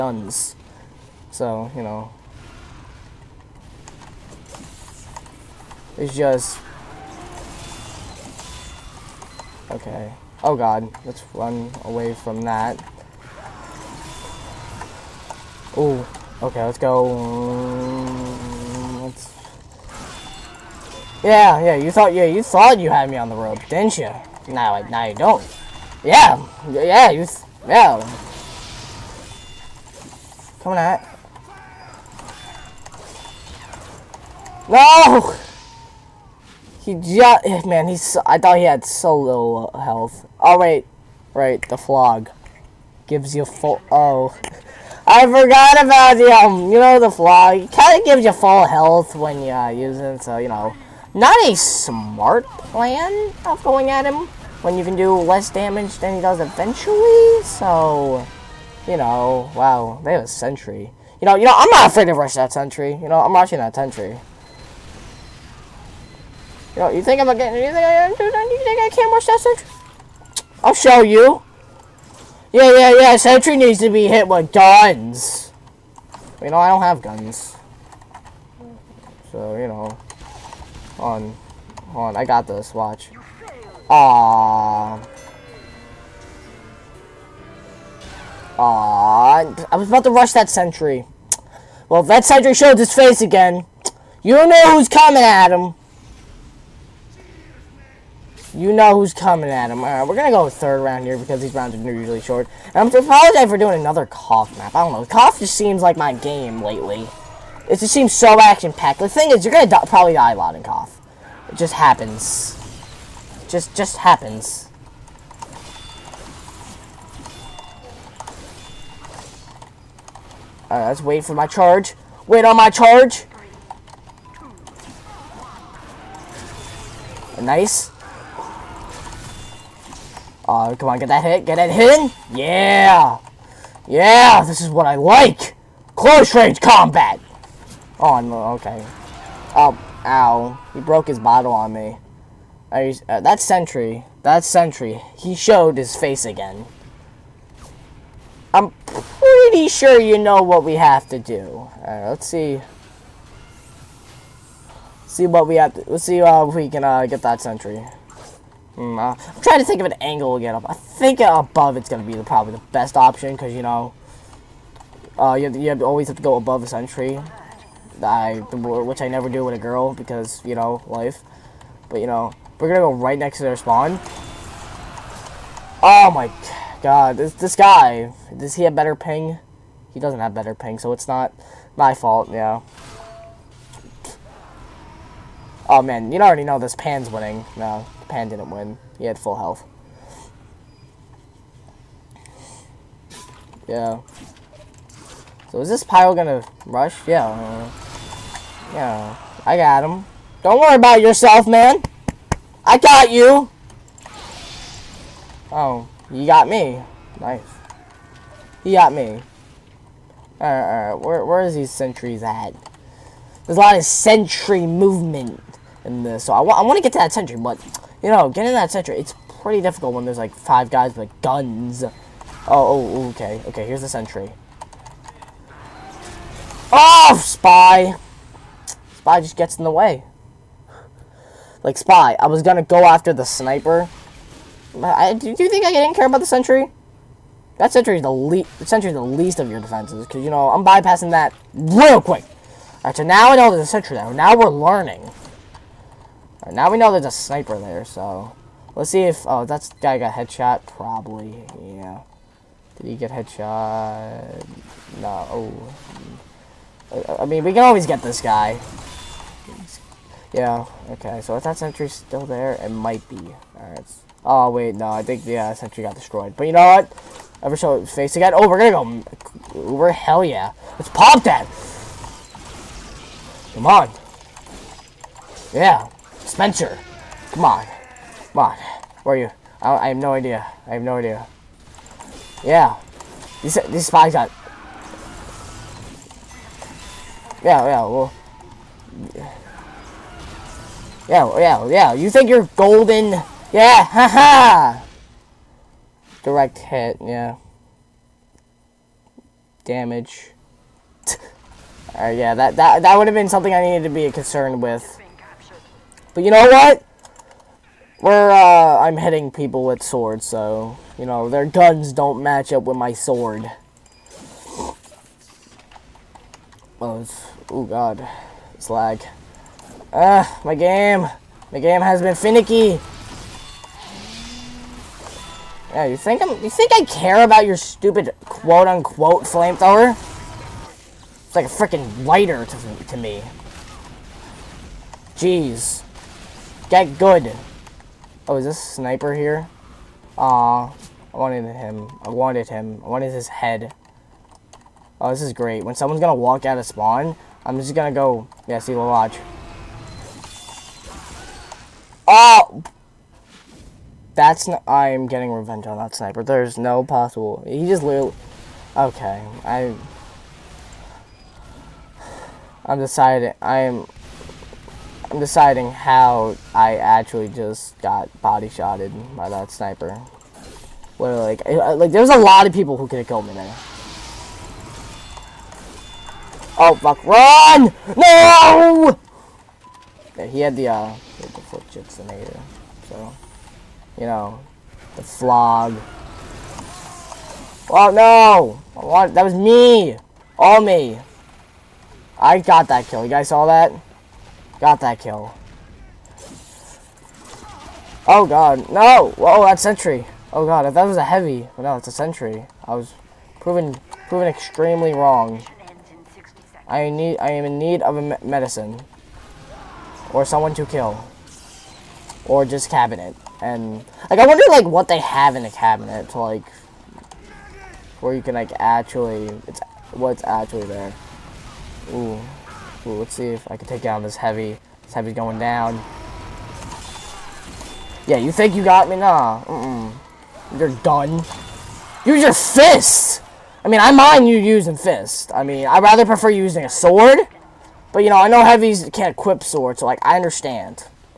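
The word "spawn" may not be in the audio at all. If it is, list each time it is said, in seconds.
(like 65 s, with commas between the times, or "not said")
173 s, 346 s.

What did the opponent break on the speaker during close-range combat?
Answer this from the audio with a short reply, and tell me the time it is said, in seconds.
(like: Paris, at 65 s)
his bottle, at 141 s.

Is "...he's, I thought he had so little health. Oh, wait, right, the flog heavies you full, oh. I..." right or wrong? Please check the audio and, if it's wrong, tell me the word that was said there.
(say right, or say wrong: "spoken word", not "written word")
wrong: "gives", not "heavies".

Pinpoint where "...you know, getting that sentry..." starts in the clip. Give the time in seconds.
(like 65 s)
218 s.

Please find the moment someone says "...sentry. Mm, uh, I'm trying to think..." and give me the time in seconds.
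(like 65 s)
157 s.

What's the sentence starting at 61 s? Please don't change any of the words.
You know, you know, I'm not afraid to rush that sentry.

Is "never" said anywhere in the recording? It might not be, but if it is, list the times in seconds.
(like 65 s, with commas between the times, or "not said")
169 s.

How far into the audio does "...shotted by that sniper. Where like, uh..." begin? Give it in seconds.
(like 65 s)
368 s.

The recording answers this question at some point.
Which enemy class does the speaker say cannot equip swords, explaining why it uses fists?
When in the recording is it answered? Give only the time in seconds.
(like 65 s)
438 s.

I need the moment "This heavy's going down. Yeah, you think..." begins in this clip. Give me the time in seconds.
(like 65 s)
424 s.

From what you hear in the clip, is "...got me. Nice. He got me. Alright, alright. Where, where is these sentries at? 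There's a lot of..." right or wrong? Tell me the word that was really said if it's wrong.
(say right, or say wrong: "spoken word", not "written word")
right.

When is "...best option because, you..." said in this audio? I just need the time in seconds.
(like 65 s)
162 s.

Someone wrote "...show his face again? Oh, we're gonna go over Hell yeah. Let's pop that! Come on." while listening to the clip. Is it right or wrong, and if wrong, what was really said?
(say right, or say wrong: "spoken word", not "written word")
right.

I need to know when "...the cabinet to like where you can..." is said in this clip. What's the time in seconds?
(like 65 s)
415 s.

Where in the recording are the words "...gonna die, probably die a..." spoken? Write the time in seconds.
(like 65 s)
109 s.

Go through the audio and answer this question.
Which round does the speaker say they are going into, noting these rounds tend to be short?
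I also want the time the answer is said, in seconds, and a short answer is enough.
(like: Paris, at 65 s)
third round, at 100 s.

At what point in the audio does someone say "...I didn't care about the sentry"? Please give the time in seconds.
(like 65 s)
235 s.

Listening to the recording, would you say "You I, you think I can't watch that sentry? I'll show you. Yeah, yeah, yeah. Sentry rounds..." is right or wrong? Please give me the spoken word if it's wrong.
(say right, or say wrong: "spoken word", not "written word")
wrong: "needs", not "rounds".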